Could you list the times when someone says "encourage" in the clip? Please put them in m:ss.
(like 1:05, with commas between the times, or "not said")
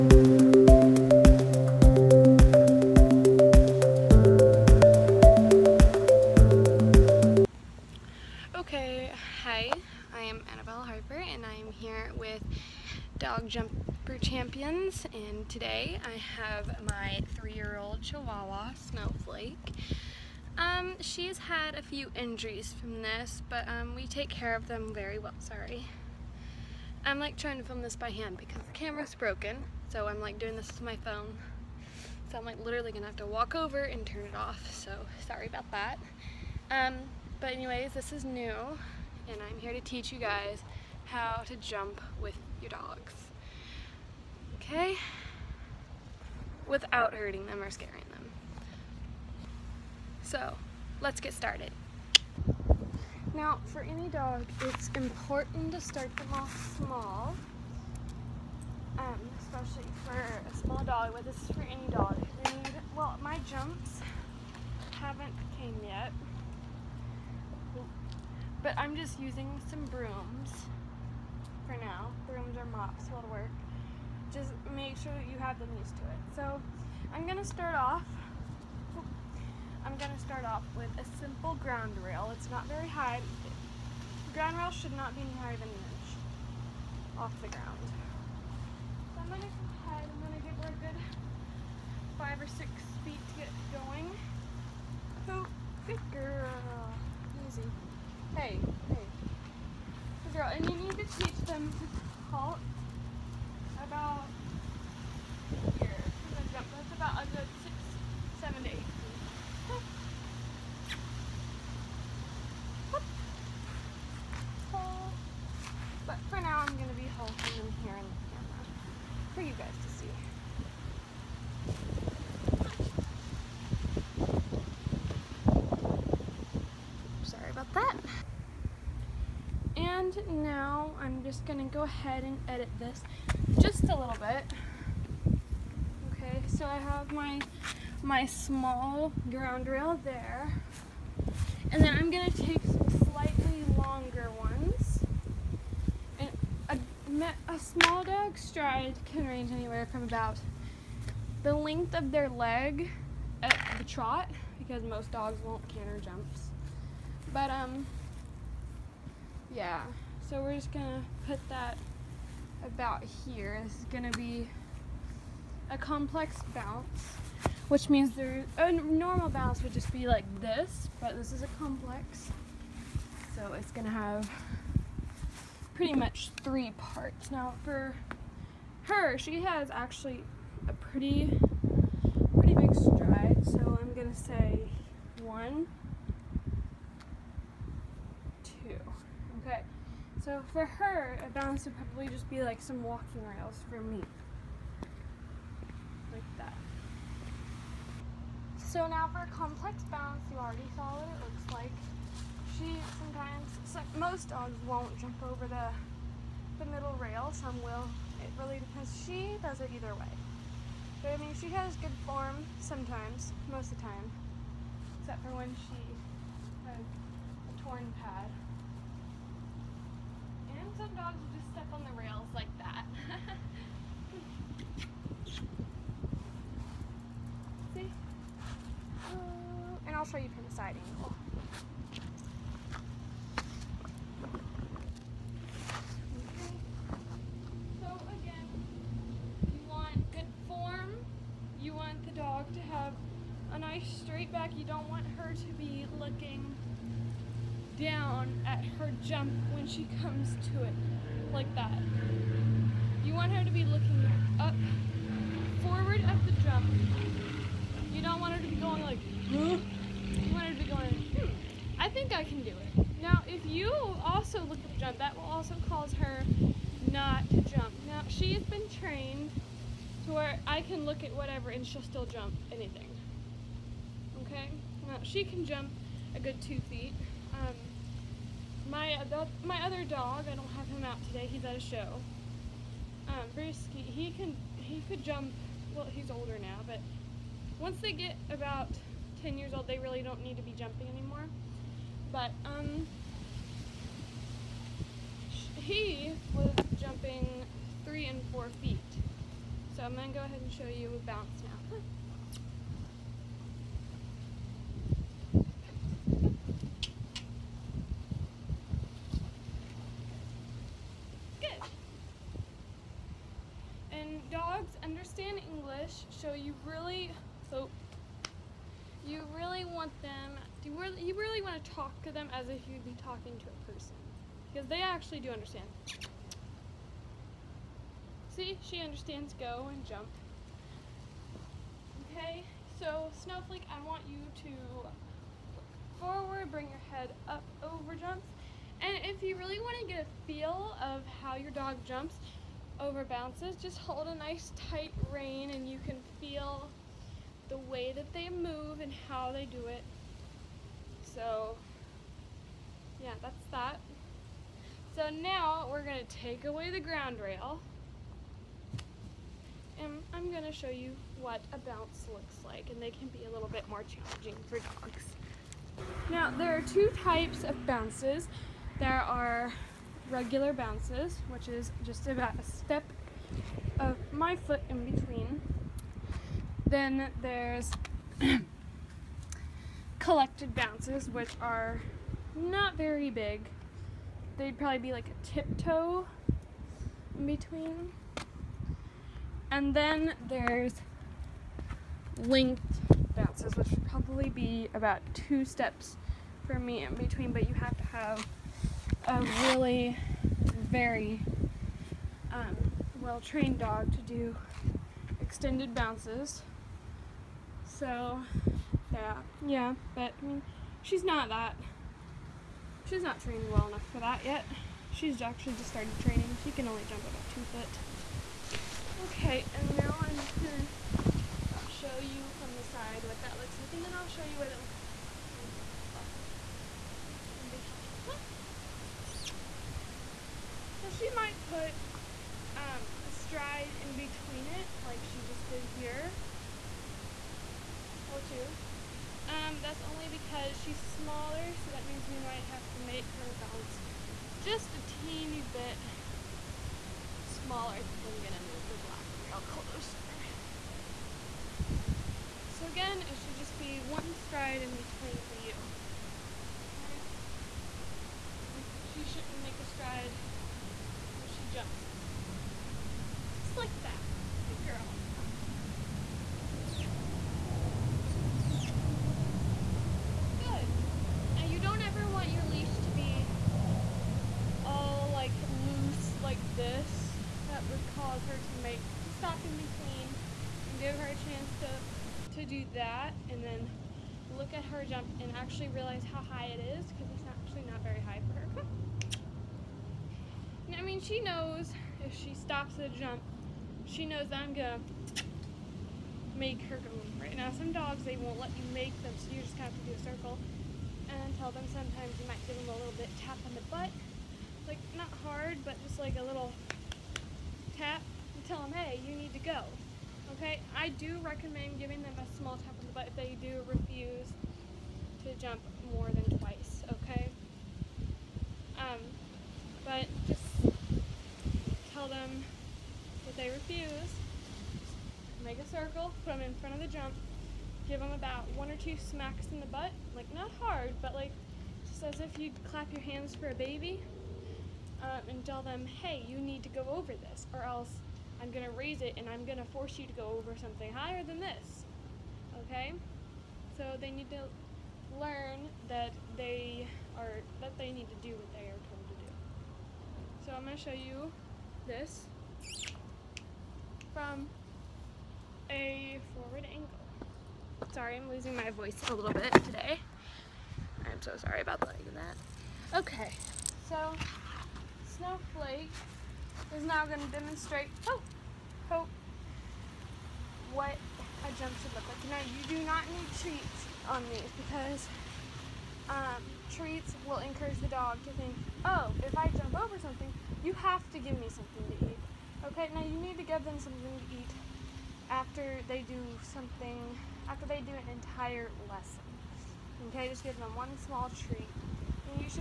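9:37.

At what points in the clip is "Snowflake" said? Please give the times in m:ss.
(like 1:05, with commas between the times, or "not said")
0:18, 5:33, 9:25.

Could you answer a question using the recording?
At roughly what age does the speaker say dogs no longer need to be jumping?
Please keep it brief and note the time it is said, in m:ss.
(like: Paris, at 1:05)
10 years old, at 4:49.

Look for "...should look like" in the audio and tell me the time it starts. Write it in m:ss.
9:31.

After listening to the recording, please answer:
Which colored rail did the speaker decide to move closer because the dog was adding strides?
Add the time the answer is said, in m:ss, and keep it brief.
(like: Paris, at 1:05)
Black rail, at 7:28.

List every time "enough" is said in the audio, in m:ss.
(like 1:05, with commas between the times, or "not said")
6:53.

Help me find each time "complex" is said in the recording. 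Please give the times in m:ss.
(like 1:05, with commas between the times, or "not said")
2:45, 2:51, 3:19.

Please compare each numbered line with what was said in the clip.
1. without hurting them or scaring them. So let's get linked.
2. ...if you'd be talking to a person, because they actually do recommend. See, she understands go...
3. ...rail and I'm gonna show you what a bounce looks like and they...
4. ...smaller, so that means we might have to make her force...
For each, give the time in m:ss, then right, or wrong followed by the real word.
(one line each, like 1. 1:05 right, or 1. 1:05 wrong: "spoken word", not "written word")
1. 0:46 wrong: "started", not "linked"
2. 5:22 wrong: "understand", not "recommend"
3. 5:57 right
4. 7:20 wrong: "bounce", not "force".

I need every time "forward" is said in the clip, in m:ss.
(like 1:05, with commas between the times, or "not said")
4:15, 5:36, 9:16.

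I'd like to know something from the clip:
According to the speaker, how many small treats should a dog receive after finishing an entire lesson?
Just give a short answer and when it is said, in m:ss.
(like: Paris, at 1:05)
1, at 9:50.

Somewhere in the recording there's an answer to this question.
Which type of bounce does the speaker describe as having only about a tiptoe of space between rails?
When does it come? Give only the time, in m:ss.
6:19.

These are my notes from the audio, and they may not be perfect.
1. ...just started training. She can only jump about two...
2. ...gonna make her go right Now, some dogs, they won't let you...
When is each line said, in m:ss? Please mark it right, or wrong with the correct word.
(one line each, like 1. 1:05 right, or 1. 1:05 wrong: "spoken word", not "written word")
1. 6:55 right
2. 8:14 right.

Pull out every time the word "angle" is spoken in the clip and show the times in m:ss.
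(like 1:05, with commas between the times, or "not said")
3:50, 9:16.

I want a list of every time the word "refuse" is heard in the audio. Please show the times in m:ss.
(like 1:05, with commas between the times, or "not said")
8:33, 8:43.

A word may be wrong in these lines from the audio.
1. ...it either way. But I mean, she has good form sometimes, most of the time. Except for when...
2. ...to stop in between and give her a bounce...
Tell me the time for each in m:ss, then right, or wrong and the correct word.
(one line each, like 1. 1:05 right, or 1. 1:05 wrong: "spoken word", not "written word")
1. 3:29 right
2. 7:59 wrong: "chance", not "bounce".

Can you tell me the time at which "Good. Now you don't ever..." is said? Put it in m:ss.
7:50.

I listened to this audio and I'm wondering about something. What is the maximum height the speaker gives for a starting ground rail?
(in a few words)
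An inch.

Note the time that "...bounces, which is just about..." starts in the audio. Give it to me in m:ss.
6:10.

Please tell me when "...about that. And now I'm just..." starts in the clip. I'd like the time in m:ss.
2:07.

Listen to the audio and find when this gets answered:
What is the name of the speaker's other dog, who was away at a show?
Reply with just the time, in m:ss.
4:43.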